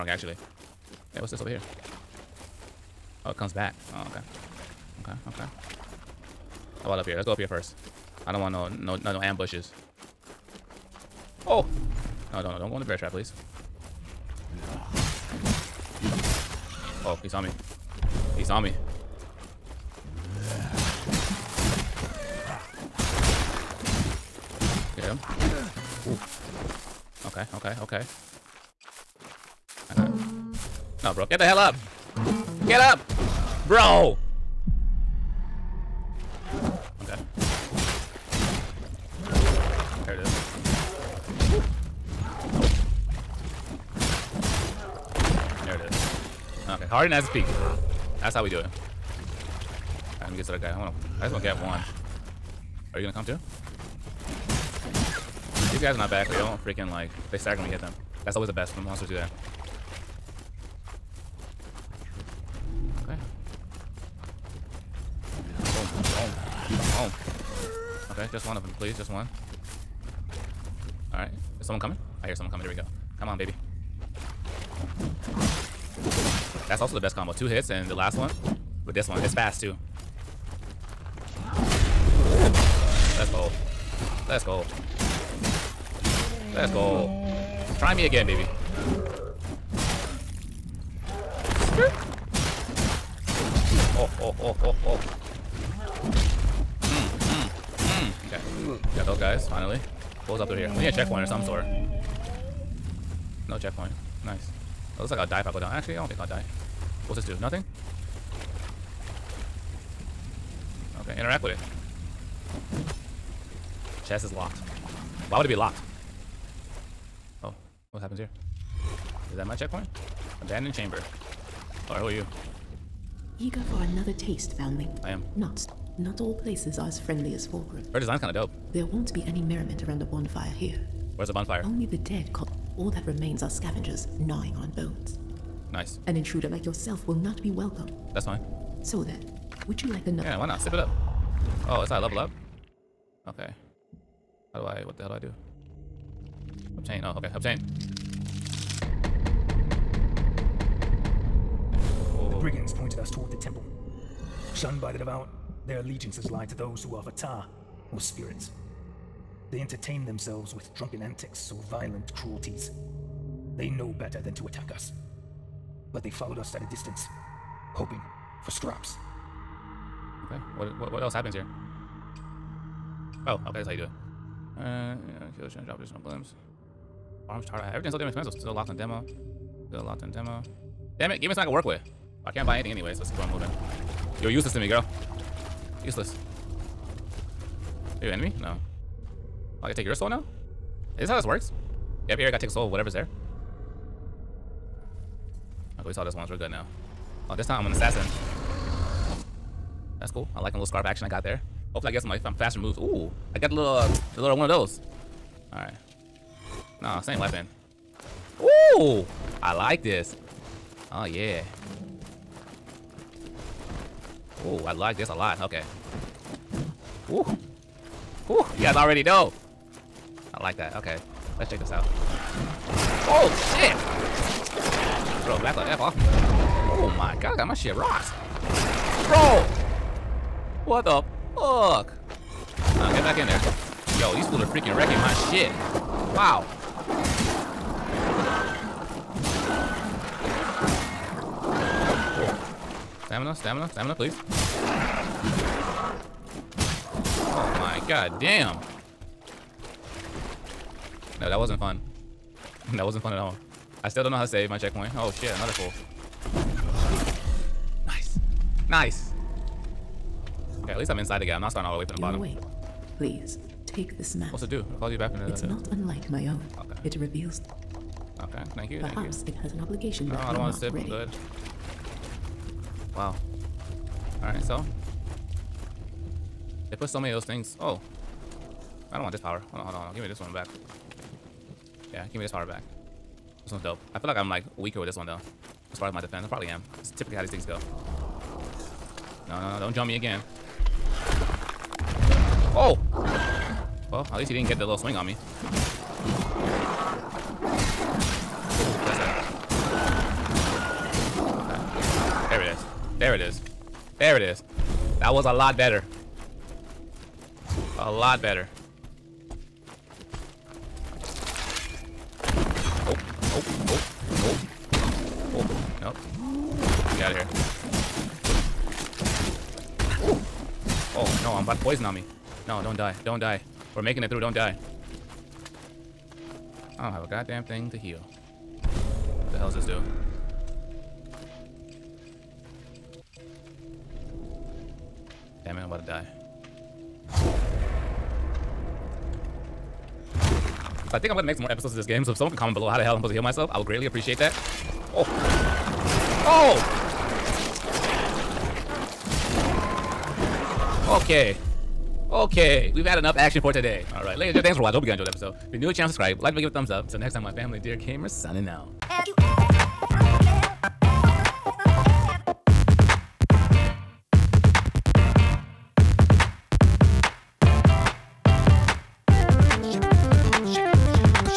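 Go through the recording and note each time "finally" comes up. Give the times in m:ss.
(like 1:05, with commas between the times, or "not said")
1:39.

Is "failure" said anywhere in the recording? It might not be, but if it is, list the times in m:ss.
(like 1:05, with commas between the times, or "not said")
not said.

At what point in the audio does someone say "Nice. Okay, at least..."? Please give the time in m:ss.
4:18.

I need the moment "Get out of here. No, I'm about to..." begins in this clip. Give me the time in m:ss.
5:16.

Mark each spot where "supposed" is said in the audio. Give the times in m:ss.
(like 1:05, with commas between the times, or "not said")
5:43.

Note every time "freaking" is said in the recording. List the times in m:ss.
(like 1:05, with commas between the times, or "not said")
0:56, 3:54.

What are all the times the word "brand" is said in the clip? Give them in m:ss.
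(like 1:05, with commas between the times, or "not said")
not said.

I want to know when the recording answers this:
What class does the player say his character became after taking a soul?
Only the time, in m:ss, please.
3:17.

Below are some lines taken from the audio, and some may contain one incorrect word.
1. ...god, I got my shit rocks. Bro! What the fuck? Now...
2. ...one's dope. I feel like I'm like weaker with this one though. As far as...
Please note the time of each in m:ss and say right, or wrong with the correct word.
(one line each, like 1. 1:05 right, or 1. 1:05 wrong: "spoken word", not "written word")
1. 3:47 right
2. 4:43 right.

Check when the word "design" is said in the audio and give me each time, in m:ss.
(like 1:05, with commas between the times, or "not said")
2:07.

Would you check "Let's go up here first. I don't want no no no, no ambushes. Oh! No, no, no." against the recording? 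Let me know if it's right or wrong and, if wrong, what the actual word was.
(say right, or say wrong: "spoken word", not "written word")
right.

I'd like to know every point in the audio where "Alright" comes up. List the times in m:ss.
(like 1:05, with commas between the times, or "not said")
1:11, 4:34.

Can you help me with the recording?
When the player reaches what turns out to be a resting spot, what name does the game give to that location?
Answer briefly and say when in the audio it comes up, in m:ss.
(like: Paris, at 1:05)
Abandoned chamber, at 2:00.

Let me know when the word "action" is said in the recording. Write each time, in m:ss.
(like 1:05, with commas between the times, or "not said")
3:20, 5:53.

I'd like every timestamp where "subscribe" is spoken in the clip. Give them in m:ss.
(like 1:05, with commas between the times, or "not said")
5:55.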